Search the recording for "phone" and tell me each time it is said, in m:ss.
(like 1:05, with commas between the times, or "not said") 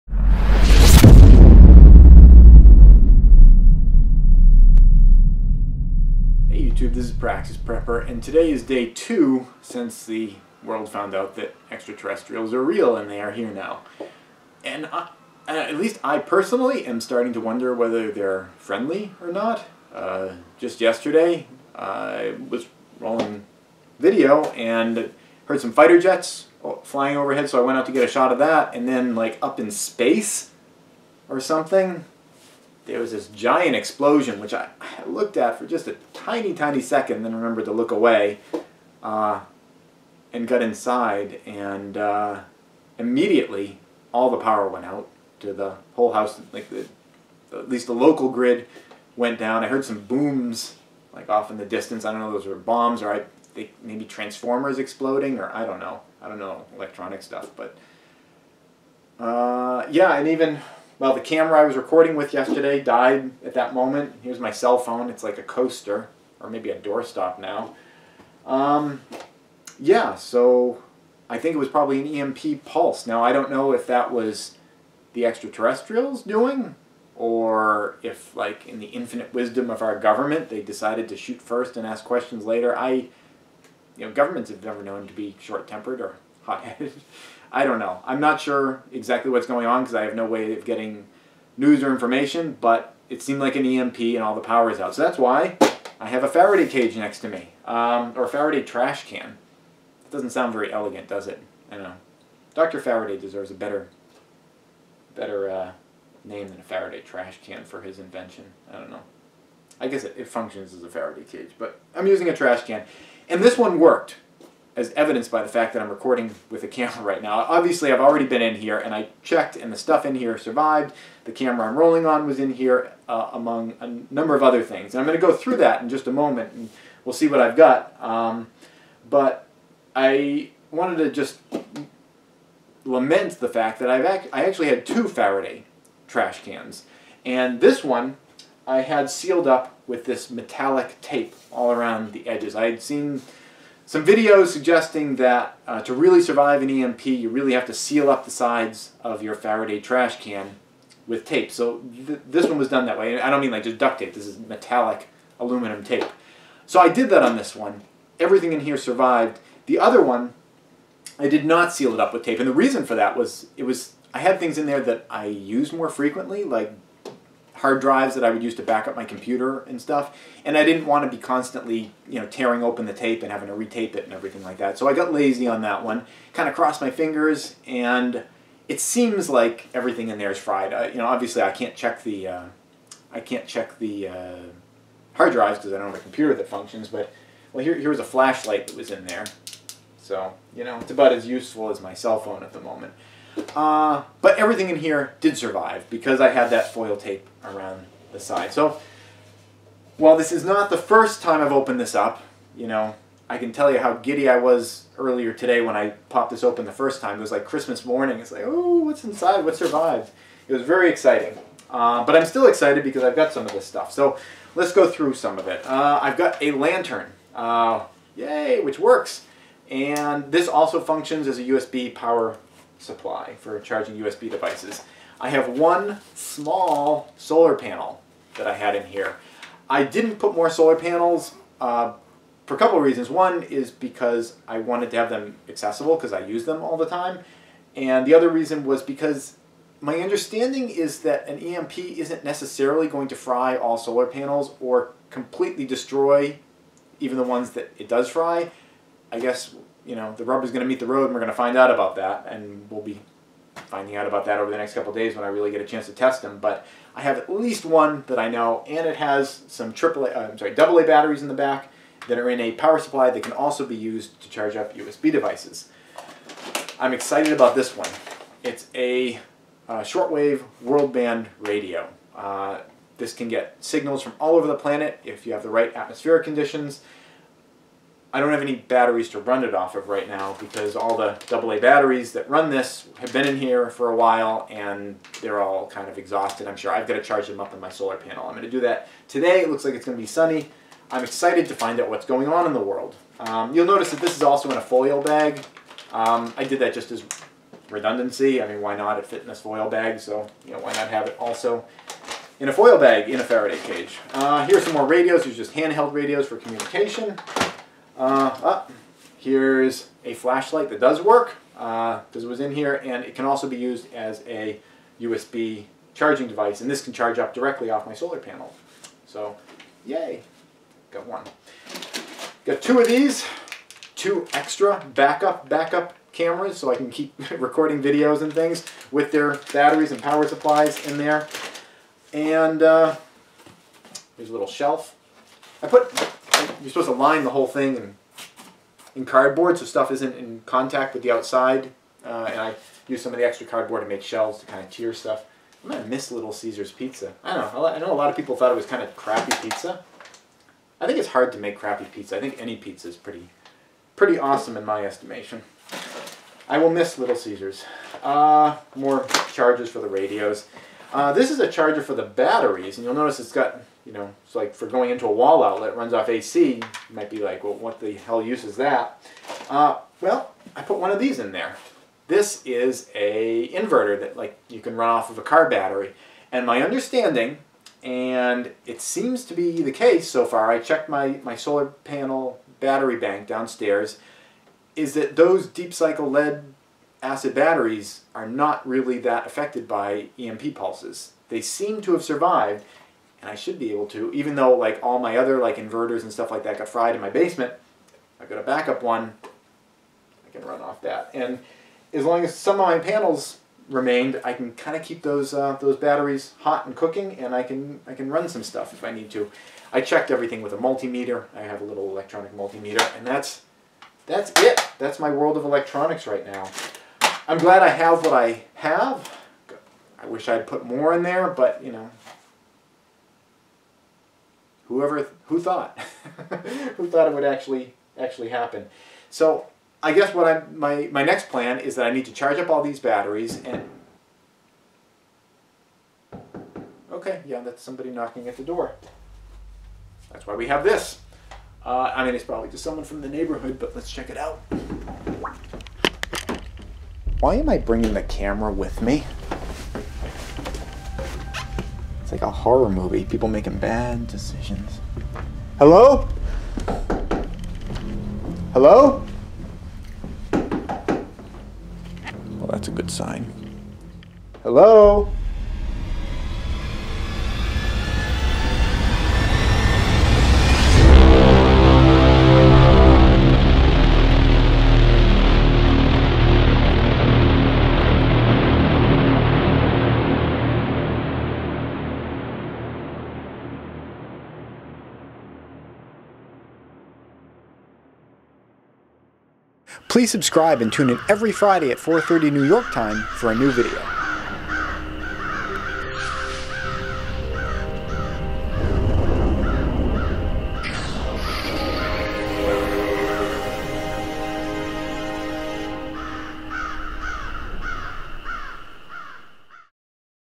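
1:04, 3:12.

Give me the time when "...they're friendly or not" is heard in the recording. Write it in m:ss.
0:18.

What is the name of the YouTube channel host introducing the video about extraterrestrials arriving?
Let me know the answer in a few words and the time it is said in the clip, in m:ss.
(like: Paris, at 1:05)
Praxis Prepper, at 0:07.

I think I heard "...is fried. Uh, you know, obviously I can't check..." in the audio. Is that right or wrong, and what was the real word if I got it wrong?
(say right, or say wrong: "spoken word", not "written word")
right.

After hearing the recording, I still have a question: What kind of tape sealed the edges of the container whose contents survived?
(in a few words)
metallic aluminum tape.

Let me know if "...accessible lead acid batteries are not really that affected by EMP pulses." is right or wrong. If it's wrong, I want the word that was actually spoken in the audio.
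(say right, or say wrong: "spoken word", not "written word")
wrong: "cycle", not "accessible".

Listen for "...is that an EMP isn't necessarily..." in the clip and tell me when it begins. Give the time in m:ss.
4:00.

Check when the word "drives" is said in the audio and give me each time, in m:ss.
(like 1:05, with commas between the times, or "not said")
2:47, 3:05.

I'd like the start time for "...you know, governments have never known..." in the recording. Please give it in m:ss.
1:23.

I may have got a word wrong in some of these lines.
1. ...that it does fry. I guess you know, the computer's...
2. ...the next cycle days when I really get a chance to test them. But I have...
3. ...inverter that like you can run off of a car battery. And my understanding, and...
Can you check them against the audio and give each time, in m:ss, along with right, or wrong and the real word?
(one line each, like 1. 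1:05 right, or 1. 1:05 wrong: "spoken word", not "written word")
1. 4:07 wrong: "rubber", not "computer"
2. 4:14 wrong: "couple", not "cycle"
3. 6:13 right.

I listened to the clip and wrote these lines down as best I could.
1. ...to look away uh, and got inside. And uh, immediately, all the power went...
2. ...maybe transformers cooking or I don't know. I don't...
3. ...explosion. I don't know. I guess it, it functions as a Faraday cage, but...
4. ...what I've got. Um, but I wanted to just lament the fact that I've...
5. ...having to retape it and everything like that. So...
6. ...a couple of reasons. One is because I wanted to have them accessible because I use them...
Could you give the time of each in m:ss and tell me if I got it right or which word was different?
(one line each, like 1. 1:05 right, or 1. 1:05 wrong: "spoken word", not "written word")
1. 0:37 right
2. 0:53 wrong: "exploding", not "cooking"
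3. 1:47 wrong: "invention", not "explosion"
4. 2:07 right
5. 2:53 right
6. 3:52 right.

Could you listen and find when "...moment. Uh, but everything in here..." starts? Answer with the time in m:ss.
3:12.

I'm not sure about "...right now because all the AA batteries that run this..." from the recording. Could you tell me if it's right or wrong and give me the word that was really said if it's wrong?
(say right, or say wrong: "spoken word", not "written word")
right.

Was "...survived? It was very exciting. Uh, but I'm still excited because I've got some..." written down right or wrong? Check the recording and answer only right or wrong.
right.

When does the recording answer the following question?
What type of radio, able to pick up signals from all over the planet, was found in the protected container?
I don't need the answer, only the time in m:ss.
4:29.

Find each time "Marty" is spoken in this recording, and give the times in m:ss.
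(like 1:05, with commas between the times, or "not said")
not said.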